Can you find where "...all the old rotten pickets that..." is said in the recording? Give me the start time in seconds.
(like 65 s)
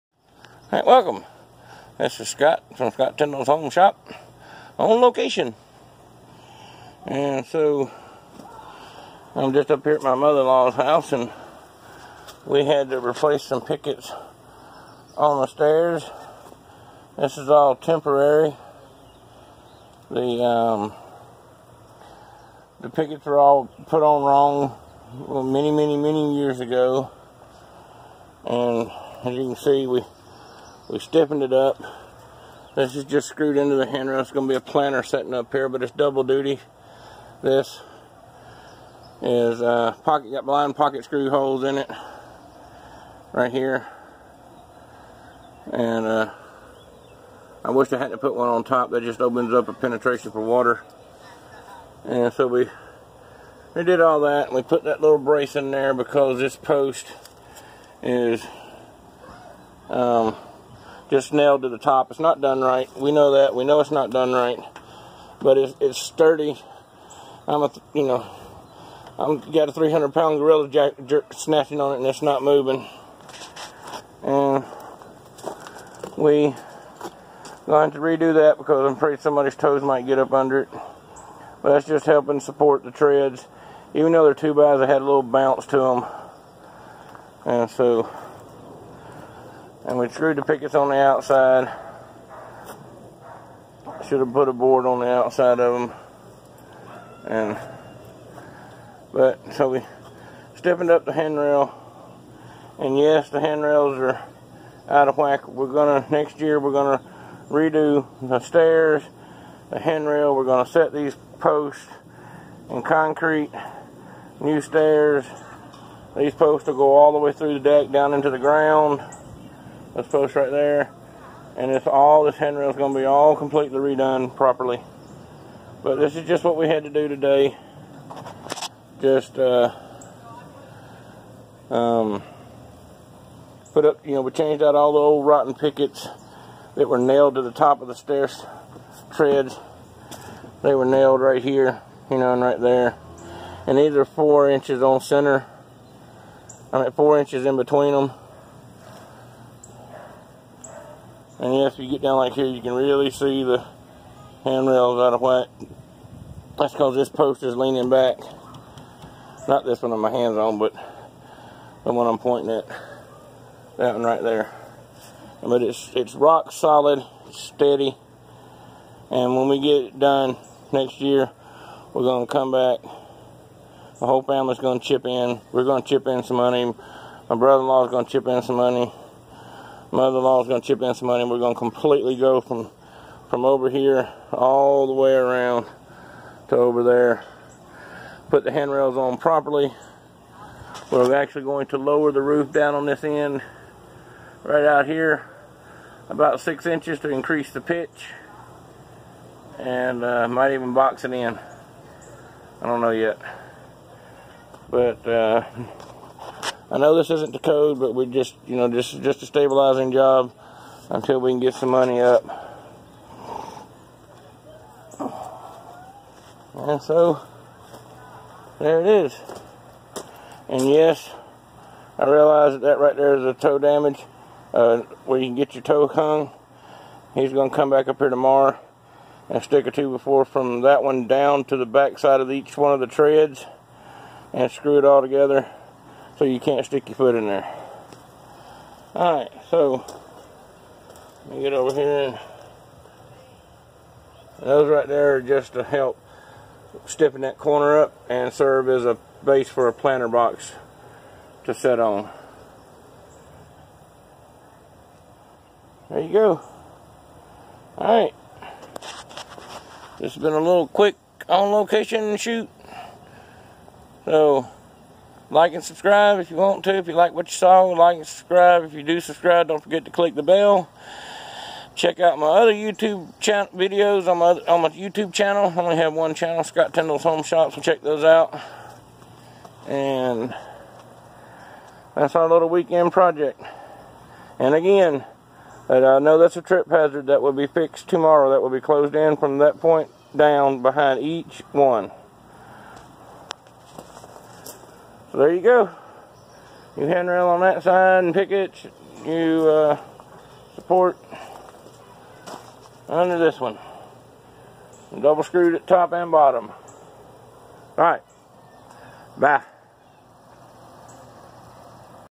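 134 s.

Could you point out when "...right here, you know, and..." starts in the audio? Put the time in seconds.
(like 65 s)
141 s.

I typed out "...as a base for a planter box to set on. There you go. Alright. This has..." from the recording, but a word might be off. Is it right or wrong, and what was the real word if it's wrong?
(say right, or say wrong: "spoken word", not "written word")
right.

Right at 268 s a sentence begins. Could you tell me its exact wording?
If you do subscribe, don't forget to click the bell.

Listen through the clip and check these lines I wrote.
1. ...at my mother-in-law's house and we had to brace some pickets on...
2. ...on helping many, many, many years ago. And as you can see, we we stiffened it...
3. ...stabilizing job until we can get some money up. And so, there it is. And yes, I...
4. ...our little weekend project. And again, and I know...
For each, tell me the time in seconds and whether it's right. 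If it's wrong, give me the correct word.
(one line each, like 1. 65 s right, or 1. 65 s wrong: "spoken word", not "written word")
1. 9 s wrong: "replace", not "brace"
2. 24 s wrong: "wrong", not "helping"
3. 209 s right
4. 282 s right.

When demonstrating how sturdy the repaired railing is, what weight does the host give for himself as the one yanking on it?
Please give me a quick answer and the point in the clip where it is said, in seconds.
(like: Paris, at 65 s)
300 pound, at 69 s.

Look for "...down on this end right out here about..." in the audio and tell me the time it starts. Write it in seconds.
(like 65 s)
192 s.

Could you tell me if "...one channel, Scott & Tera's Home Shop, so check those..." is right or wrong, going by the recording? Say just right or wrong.
right.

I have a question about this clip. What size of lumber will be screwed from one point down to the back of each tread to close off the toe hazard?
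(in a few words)
two by four.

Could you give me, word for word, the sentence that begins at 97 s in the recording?
And, but, so we stiffened up the handrail.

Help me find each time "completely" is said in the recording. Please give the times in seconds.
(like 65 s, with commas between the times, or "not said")
123 s, 181 s.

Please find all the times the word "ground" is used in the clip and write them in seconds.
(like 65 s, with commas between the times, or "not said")
118 s.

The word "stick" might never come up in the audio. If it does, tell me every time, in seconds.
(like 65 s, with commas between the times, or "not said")
229 s, 236 s.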